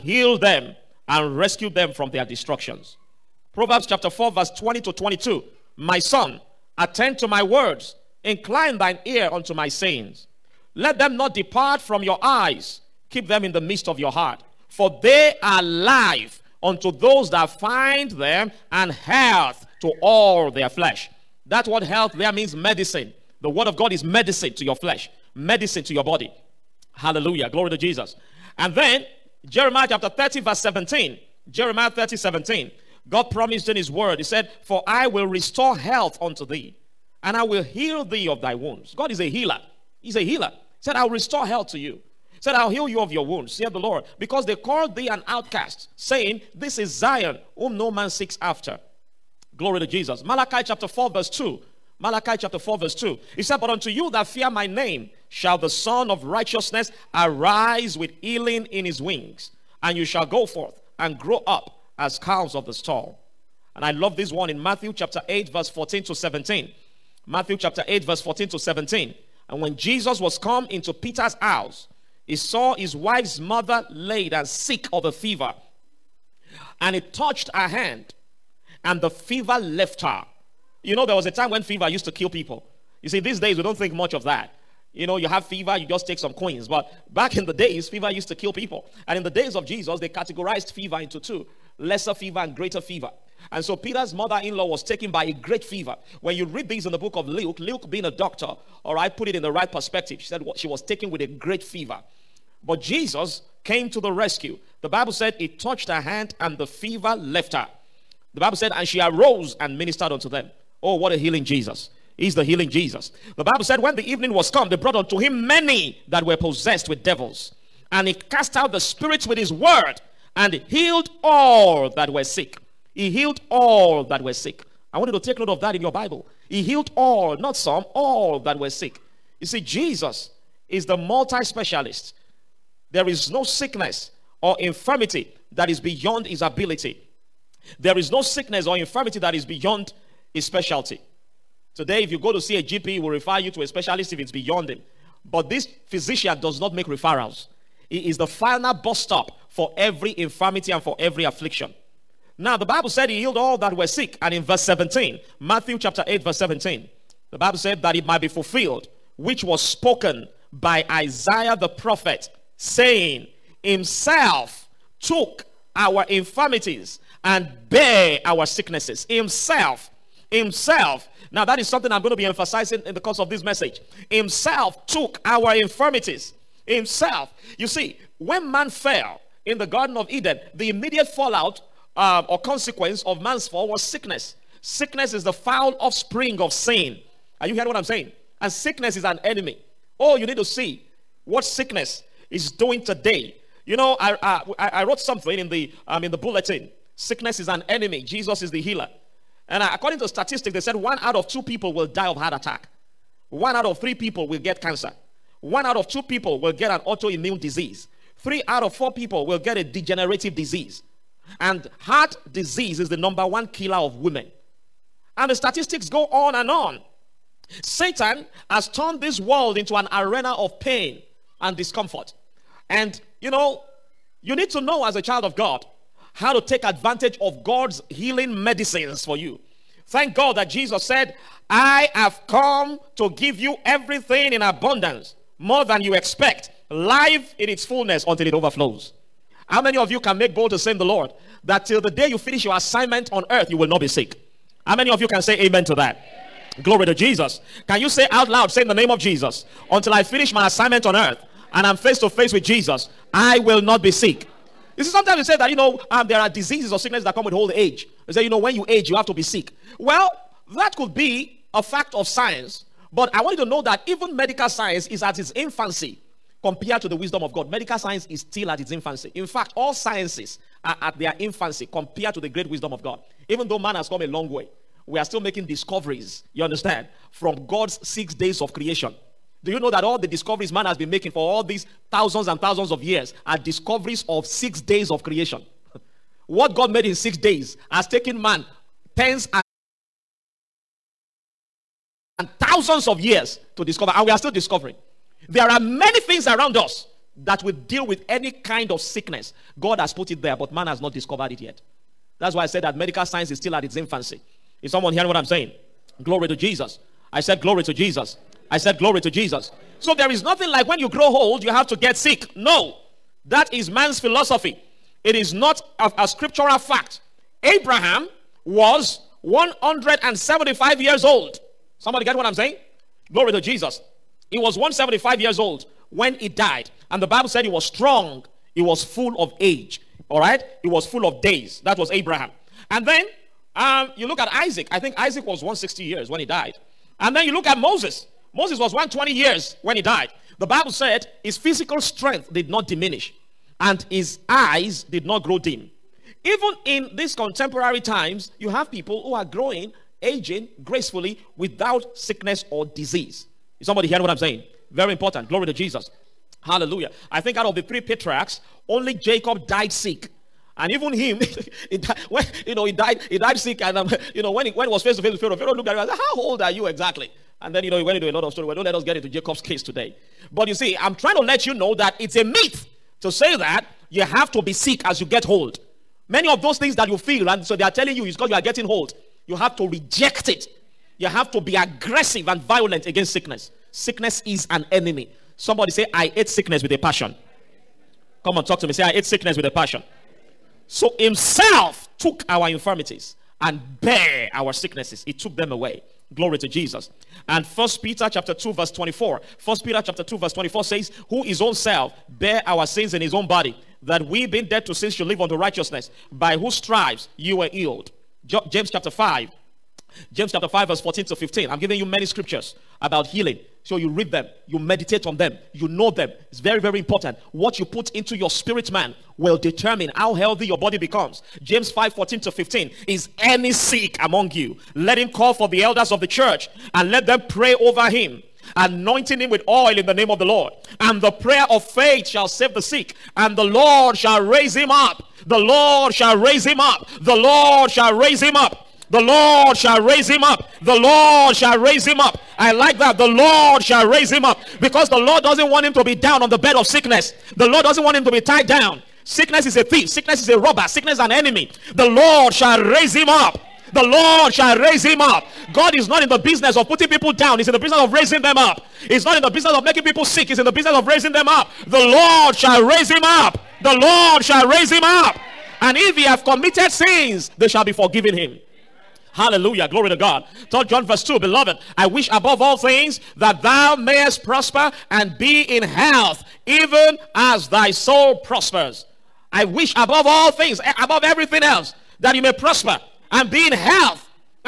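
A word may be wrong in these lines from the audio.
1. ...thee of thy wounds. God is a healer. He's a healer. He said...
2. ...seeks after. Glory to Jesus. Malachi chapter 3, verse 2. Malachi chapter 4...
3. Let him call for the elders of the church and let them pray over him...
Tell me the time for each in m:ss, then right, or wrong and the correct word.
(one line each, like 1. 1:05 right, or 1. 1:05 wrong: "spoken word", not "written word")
1. 0:38 right
2. 0:48 wrong: "4", not "3"
3. 7:04 right.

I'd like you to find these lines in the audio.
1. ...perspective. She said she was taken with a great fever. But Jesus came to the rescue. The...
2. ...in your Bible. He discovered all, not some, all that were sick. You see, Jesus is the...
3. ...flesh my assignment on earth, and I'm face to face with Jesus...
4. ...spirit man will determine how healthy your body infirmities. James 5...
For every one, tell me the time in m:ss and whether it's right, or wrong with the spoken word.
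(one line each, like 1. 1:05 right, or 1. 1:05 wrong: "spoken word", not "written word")
1. 1:39 right
2. 2:05 wrong: "healed", not "discovered"
3. 4:10 wrong: "finish", not "flesh"
4. 6:58 wrong: "becomes", not "infirmities".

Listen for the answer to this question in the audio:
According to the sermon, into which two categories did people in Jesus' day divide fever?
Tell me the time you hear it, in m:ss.
1:31.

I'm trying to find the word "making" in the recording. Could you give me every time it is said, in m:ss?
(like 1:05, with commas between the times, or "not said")
4:35, 4:40, 7:39.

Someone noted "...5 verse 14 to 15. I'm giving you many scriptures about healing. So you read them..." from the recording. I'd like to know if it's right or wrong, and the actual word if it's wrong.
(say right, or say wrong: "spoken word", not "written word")
right.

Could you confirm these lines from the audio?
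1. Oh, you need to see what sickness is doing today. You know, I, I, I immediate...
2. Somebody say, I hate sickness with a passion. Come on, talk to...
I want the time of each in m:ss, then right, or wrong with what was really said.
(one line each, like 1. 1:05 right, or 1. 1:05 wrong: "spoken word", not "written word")
1. 3:09 wrong: "wrote", not "immediate"
2. 6:25 right.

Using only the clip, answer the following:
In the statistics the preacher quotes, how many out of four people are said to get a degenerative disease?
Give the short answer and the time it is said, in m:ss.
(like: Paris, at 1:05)
3, at 3:28.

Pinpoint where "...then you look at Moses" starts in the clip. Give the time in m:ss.
5:37.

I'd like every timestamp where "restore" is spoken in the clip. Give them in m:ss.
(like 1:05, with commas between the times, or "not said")
0:35, 0:41.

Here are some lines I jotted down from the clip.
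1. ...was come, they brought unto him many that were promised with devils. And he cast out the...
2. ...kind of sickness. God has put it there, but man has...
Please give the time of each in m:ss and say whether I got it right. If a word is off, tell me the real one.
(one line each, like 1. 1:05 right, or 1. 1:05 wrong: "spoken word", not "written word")
1. 1:54 wrong: "possessed", not "promised"
2. 4:58 right.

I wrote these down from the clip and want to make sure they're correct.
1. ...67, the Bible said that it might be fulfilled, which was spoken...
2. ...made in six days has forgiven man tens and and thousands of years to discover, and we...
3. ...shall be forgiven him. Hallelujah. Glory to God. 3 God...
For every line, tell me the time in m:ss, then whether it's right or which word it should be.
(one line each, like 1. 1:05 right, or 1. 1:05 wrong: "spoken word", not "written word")
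1. 2:36 wrong: "17", not "67"
2. 4:46 wrong: "taken", not "forgiven"
3. 7:47 wrong: "John", not "God".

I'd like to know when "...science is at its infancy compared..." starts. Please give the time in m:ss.
4:24.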